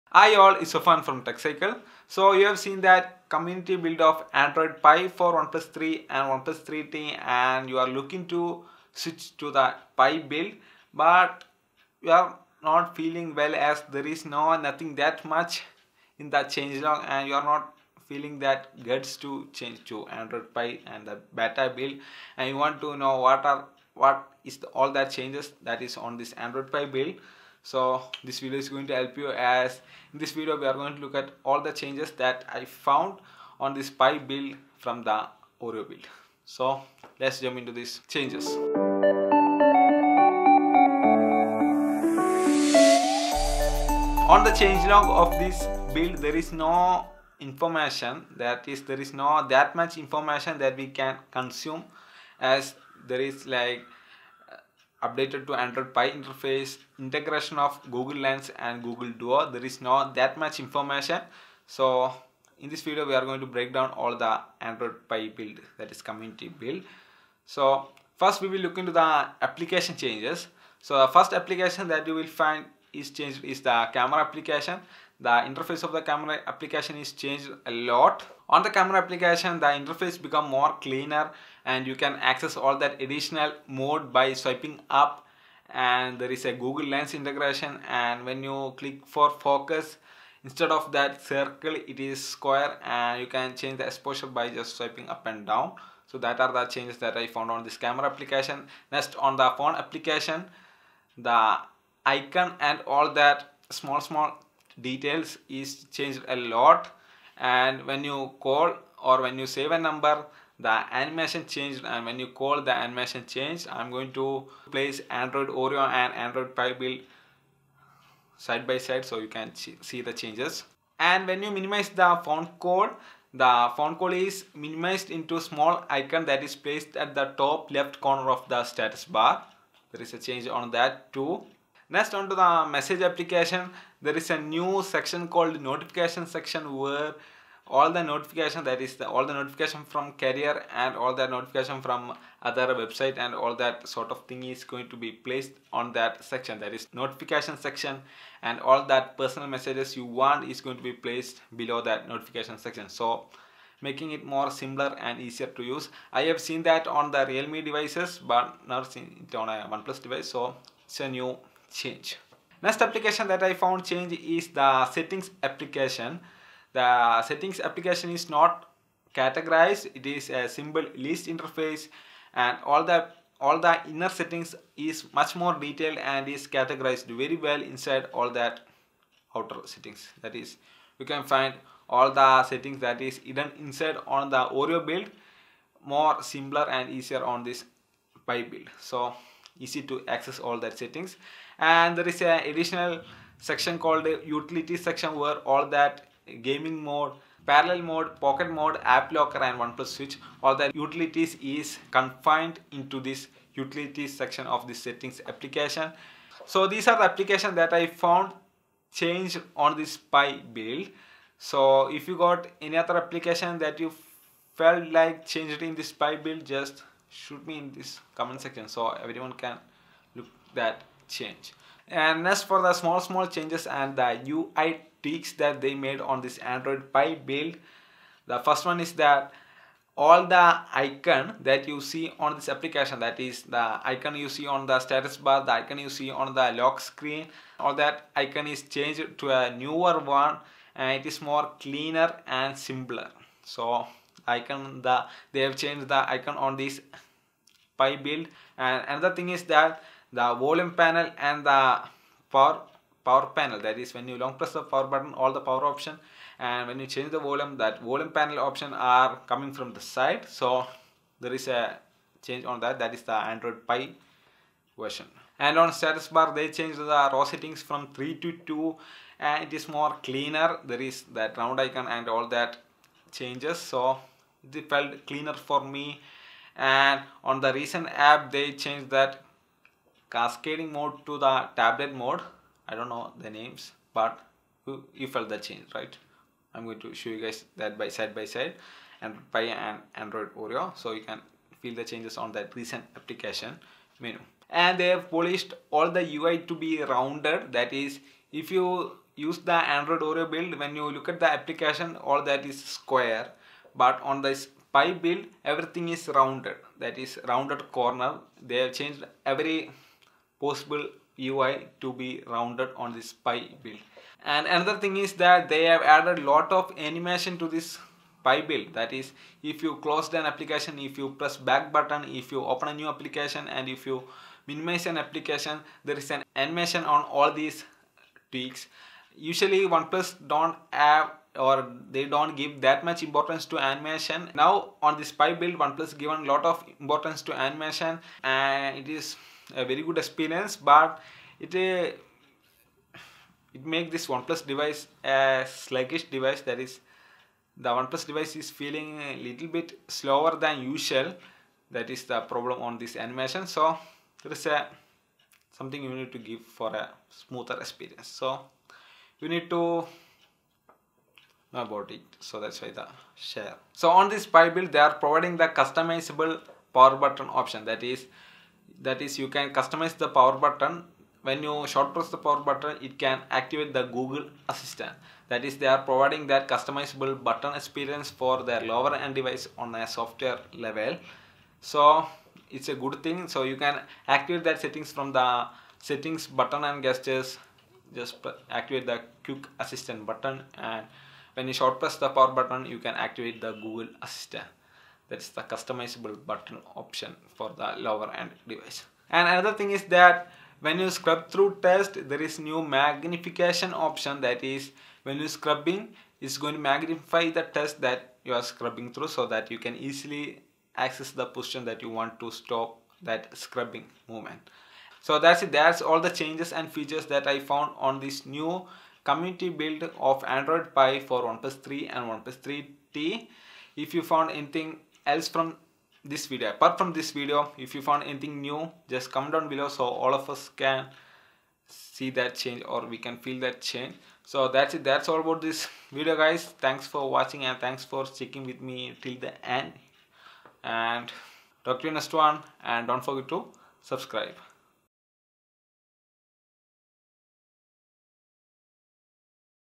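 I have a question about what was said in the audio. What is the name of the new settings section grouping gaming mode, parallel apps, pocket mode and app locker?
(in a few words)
utility section.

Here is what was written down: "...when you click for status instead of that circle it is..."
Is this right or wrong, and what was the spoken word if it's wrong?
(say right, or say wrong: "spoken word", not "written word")
wrong: "focus", not "status".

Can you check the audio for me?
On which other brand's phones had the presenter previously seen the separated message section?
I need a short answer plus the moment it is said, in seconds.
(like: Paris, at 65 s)
Realme, at 157 s.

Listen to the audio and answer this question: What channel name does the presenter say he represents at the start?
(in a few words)
TechCycle.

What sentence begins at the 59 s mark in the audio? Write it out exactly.
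There is not that much information.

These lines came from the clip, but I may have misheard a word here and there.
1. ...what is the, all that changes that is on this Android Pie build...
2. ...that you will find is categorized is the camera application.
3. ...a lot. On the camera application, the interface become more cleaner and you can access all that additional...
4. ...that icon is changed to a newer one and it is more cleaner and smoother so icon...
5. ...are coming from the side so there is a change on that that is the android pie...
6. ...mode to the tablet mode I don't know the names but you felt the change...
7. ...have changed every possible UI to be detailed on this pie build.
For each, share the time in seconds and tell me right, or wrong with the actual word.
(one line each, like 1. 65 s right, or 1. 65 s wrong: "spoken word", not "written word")
1. 23 s right
2. 71 s wrong: "changed", not "categorized"
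3. 77 s right
4. 237 s wrong: "simpler", not "smoother"
5. 258 s right
6. 280 s right
7. 308 s wrong: "rounded", not "detailed".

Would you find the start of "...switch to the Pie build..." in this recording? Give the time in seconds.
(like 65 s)
8 s.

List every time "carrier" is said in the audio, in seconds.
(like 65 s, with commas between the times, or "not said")
140 s.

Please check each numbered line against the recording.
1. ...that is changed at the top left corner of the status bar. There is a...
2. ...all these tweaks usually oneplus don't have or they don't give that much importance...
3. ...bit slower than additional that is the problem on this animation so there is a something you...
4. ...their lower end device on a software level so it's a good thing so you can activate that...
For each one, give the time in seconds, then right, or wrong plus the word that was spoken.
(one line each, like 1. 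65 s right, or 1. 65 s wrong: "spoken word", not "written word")
1. 126 s wrong: "placed", not "changed"
2. 327 s right
3. 349 s wrong: "usual", not "additional"
4. 378 s right.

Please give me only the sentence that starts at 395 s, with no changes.
That's the customizable button option for the lower end device.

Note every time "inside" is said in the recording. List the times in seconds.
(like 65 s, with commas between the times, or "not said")
177 s, 183 s.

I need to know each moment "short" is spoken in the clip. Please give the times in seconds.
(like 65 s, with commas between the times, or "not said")
371 s, 391 s.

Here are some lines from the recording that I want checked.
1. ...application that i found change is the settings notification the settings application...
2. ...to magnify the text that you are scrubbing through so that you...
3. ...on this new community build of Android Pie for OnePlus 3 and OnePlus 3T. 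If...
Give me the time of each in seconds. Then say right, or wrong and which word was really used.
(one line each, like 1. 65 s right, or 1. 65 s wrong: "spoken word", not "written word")
1. 162 s wrong: "application", not "notification"
2. 406 s right
3. 417 s right.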